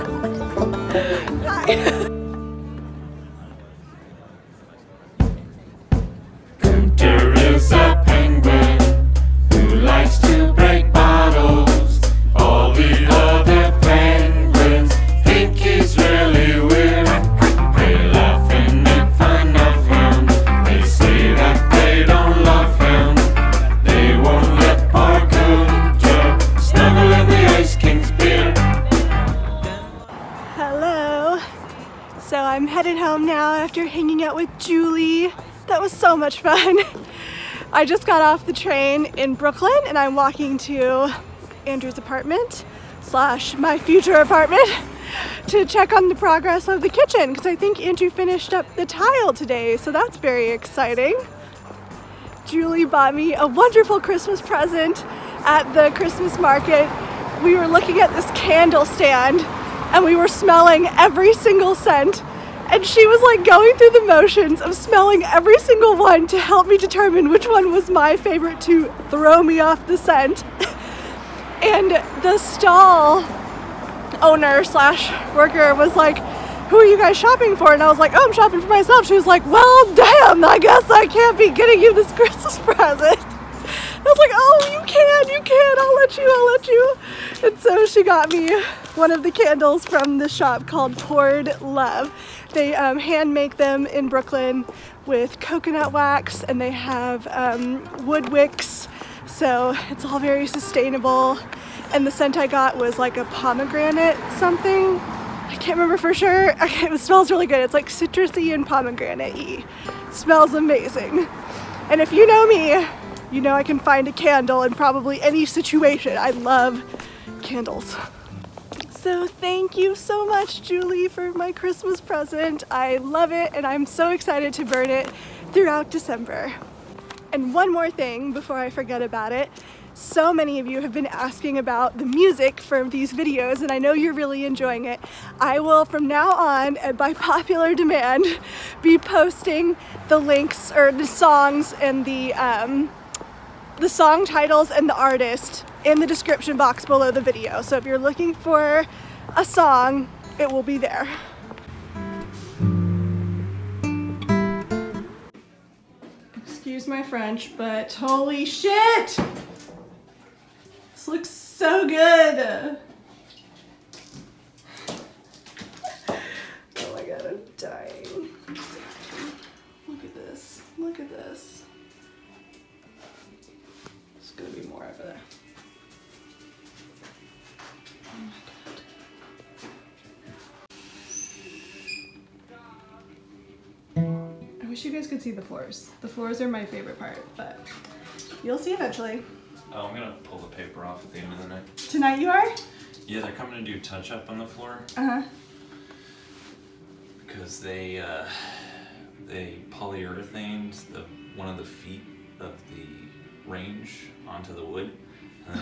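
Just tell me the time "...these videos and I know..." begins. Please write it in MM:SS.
02:12.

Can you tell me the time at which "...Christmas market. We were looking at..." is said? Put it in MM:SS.
00:55.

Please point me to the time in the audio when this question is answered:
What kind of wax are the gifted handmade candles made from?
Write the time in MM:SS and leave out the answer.
01:35.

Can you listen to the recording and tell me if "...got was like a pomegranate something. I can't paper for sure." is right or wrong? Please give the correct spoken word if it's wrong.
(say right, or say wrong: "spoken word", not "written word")
wrong: "remember", not "paper".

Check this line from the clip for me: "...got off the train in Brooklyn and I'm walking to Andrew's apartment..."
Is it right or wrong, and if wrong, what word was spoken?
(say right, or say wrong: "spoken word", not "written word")
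right.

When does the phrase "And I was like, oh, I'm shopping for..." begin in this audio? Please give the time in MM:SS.
01:17.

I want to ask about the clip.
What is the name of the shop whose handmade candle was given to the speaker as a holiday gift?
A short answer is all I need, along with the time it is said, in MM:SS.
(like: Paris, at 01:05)
Toward Love, at 01:30.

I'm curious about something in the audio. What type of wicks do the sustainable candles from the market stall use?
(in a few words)
Wood wicks.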